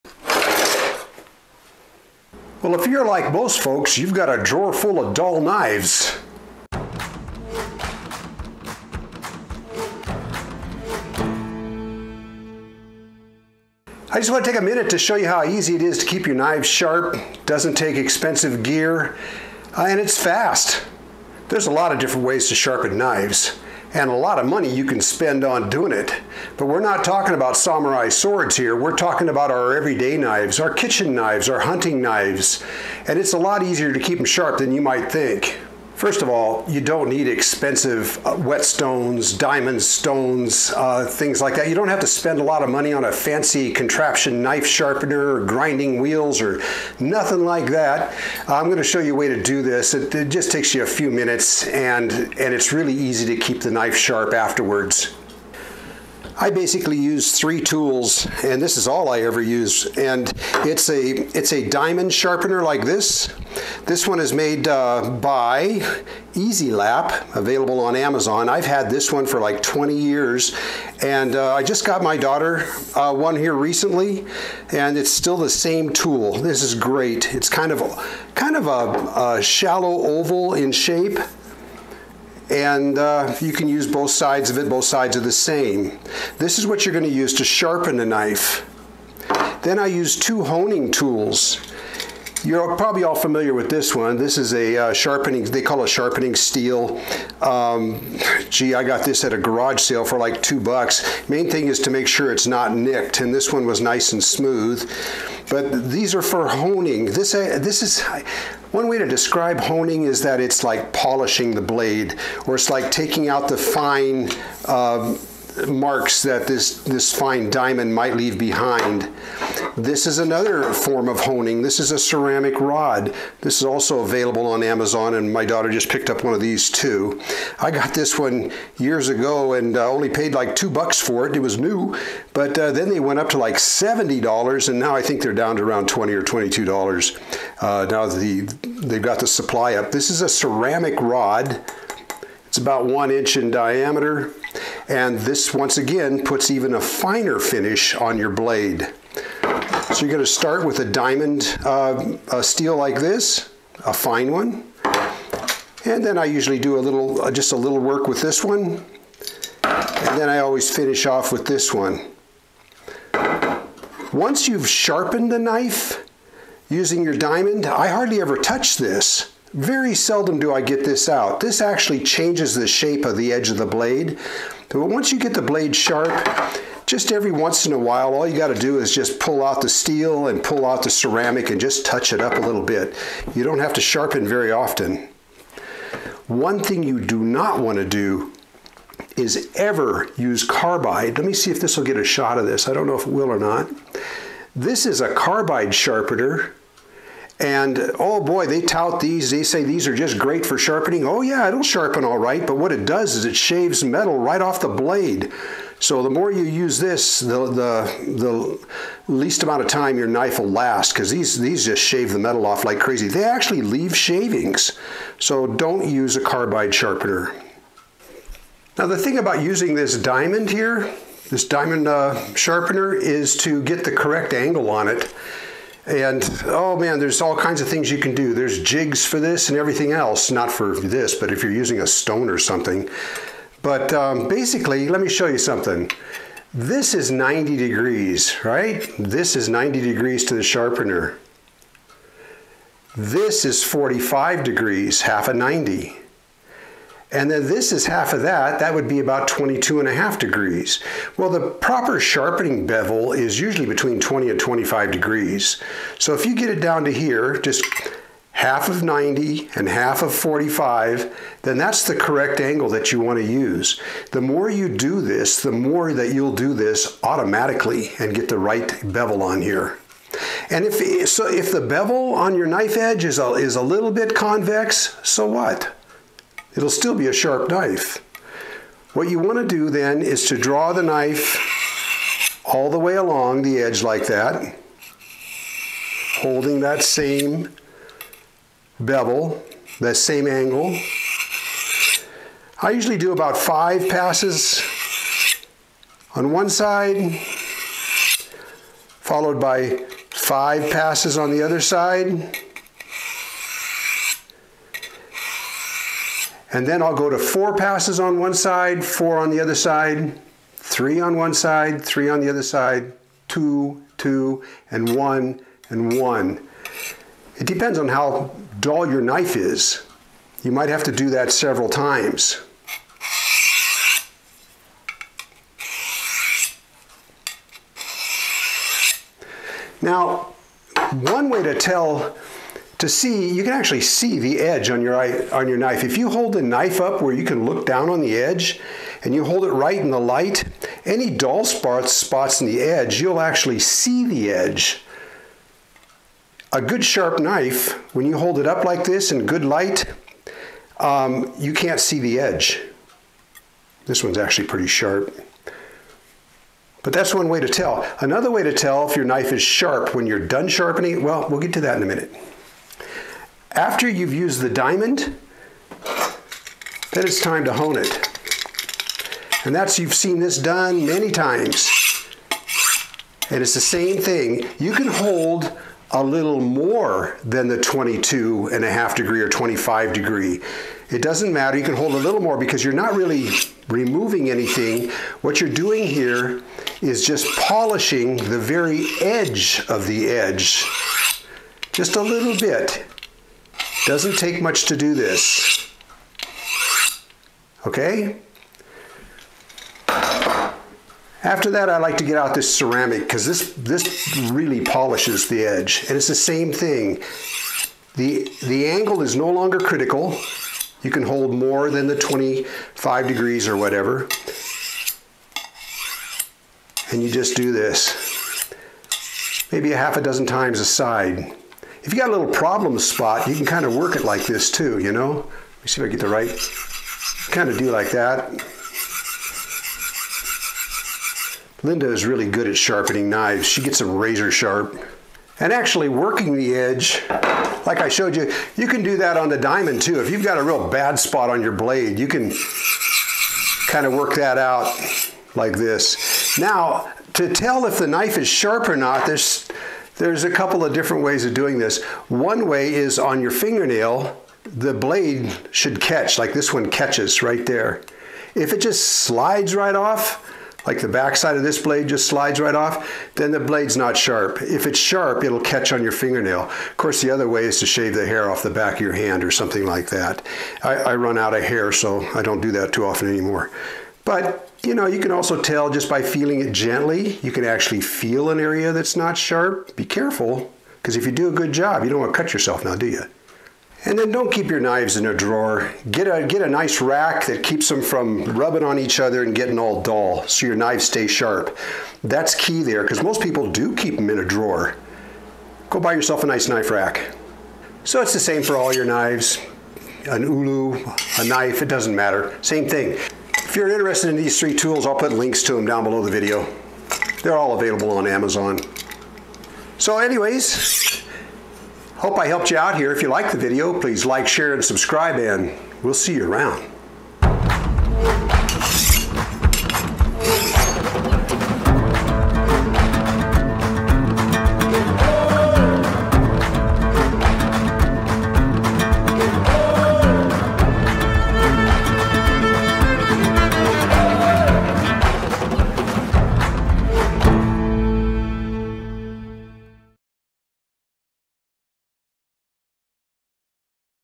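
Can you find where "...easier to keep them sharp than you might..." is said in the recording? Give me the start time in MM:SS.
00:33.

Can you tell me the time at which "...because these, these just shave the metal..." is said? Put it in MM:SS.
03:30.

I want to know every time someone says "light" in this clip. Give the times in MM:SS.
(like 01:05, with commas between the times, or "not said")
05:39, 05:49.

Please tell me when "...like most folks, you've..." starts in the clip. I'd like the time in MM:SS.
00:03.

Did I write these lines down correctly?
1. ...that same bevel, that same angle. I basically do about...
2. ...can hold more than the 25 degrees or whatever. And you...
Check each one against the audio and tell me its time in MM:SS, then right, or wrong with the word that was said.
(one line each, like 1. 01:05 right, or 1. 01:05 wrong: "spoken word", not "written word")
1. 04:46 wrong: "usually", not "basically"
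2. 06:50 right.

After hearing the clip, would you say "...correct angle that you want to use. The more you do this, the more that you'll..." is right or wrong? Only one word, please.
right.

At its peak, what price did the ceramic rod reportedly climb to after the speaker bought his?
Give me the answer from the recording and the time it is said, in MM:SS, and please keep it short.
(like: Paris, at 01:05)
$70, at 02:13.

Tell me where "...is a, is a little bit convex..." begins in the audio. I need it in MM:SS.
04:33.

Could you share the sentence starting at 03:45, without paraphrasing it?
And oh man, there's all kinds of things you can do.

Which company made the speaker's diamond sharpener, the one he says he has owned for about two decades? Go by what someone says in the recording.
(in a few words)
EZE-LAP.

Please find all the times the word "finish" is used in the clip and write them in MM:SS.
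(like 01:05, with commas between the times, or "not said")
02:27, 02:40.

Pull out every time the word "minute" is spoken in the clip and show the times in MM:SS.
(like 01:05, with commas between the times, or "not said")
00:14, 00:51, 06:01.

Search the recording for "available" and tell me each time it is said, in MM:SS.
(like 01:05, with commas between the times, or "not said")
01:07, 02:03, 08:27.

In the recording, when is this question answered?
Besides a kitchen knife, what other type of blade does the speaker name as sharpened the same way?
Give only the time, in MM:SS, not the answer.
08:20.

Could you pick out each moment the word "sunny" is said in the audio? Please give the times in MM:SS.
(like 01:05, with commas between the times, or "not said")
not said.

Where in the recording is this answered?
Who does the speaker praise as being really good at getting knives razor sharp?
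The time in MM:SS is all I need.
07:11.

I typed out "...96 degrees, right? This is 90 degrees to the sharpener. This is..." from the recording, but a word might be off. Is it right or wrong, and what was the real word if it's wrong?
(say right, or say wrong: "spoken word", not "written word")
wrong: "90", not "96".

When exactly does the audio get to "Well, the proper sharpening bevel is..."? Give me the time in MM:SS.
04:11.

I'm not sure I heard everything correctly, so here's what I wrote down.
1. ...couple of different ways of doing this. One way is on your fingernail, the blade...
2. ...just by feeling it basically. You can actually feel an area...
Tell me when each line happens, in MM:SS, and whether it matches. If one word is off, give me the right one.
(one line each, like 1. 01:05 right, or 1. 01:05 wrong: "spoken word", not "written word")
1. 07:30 right
2. 07:55 wrong: "gently", not "basically".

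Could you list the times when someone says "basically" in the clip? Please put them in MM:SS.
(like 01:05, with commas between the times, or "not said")
00:56, 03:54.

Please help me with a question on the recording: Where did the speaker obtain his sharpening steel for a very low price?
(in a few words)
garage sale.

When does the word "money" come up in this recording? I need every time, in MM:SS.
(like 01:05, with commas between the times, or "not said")
00:24, 00:42.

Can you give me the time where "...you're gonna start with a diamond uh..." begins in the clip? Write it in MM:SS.
02:30.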